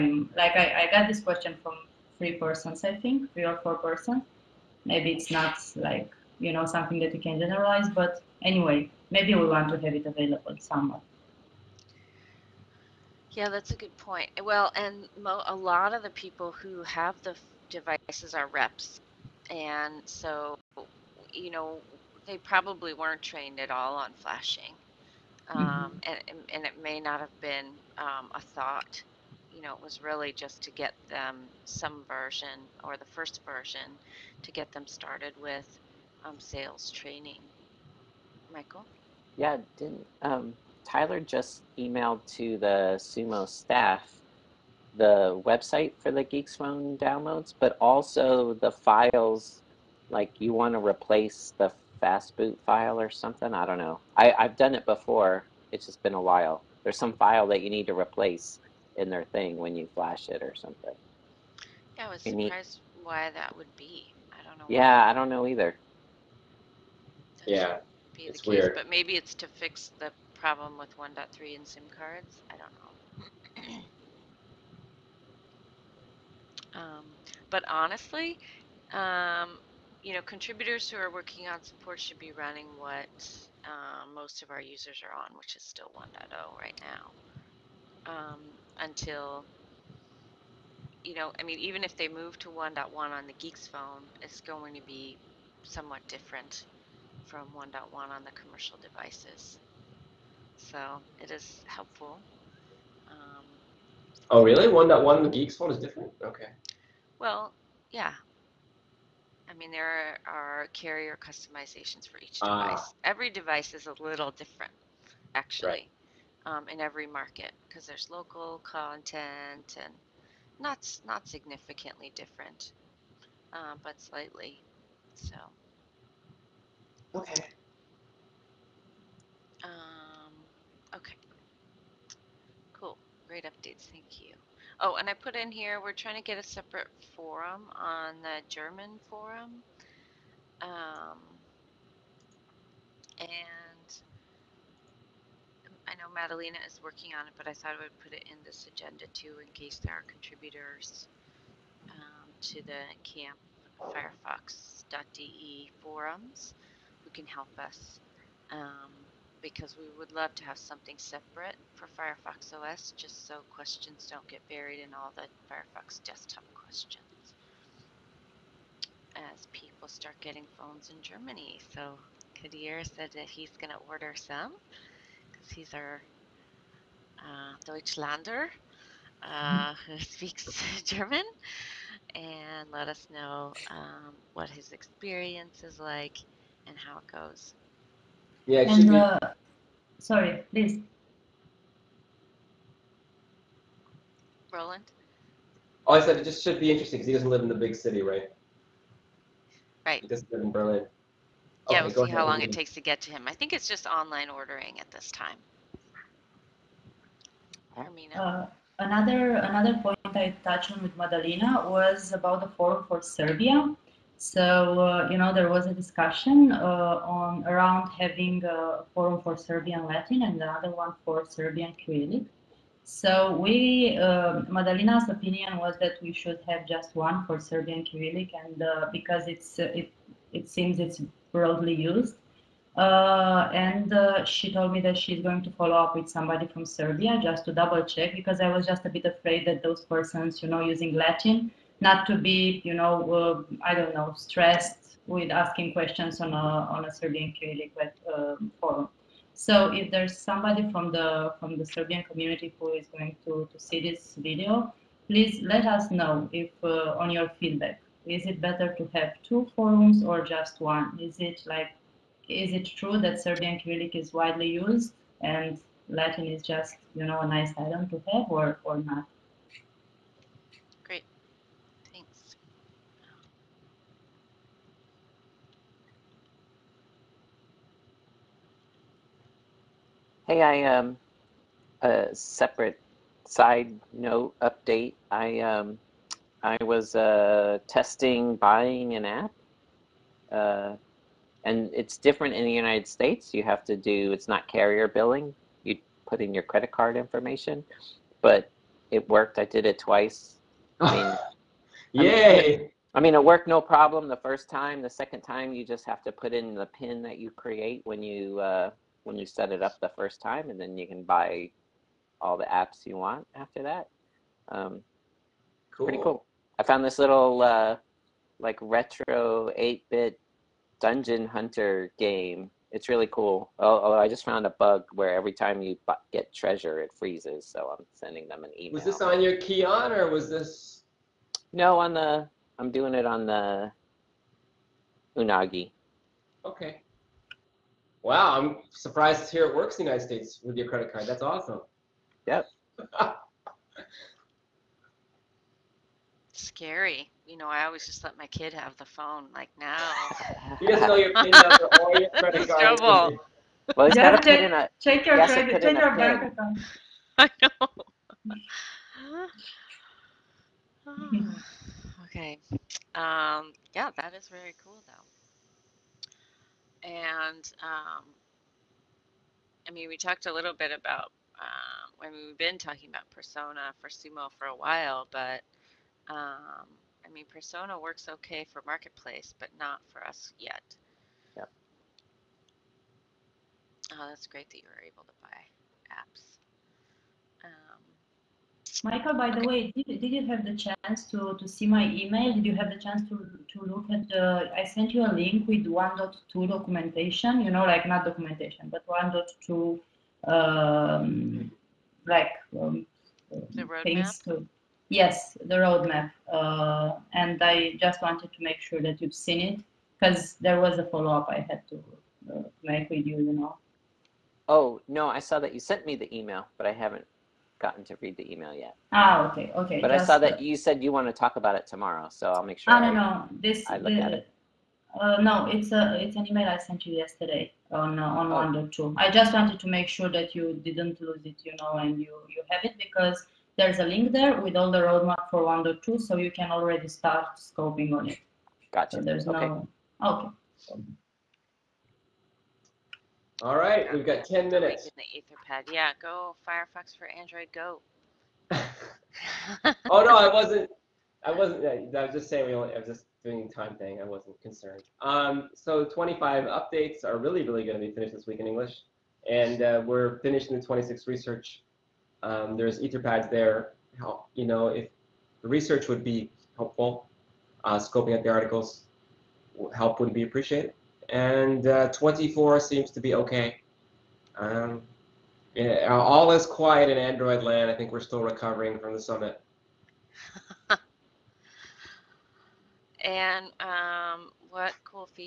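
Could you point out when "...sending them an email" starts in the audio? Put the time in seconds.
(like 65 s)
327 s.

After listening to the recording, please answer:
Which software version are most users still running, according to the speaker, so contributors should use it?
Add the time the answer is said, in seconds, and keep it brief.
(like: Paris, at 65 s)
1.0, at 85 s.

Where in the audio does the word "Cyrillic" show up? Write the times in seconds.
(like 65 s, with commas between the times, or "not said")
221 s, 227 s, 263 s.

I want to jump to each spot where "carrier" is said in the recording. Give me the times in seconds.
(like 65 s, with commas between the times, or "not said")
110 s, 294 s.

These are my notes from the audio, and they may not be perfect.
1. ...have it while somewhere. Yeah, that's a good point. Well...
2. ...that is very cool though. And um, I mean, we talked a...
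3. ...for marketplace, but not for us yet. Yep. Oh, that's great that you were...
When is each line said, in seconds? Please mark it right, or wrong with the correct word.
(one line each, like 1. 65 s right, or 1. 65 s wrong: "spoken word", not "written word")
1. 9 s wrong: "available", not "while"
2. 363 s right
3. 378 s right.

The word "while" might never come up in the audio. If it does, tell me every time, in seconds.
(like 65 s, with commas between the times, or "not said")
56 s, 374 s.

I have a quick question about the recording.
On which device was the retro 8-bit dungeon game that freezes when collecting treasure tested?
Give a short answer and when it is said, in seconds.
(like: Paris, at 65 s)
Unagi, at 335 s.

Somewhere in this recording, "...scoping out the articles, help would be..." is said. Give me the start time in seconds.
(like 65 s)
467 s.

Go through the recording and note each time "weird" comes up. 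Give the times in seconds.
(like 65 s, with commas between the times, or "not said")
68 s.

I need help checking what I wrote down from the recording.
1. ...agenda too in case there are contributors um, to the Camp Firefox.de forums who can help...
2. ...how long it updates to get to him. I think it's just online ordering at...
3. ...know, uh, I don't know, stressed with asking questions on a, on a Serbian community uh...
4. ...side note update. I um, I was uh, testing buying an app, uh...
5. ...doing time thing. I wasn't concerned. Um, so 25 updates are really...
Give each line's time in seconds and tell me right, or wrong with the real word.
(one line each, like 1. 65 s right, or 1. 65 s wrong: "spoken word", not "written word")
1. 148 s right
2. 202 s wrong: "takes", not "updates"
3. 242 s right
4. 283 s right
5. 453 s right.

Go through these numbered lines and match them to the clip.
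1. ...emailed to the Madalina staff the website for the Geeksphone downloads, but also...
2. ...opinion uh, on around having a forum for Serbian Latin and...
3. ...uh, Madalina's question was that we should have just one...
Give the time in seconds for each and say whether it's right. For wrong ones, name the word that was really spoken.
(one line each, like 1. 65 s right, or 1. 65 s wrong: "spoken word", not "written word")
1. 41 s wrong: "Sumo", not "Madalina"
2. 215 s wrong: "discussion", not "opinion"
3. 223 s wrong: "opinion", not "question".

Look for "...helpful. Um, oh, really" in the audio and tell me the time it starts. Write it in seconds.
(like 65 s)
101 s.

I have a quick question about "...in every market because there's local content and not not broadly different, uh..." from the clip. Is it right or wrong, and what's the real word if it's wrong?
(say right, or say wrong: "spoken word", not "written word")
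wrong: "significantly", not "broadly".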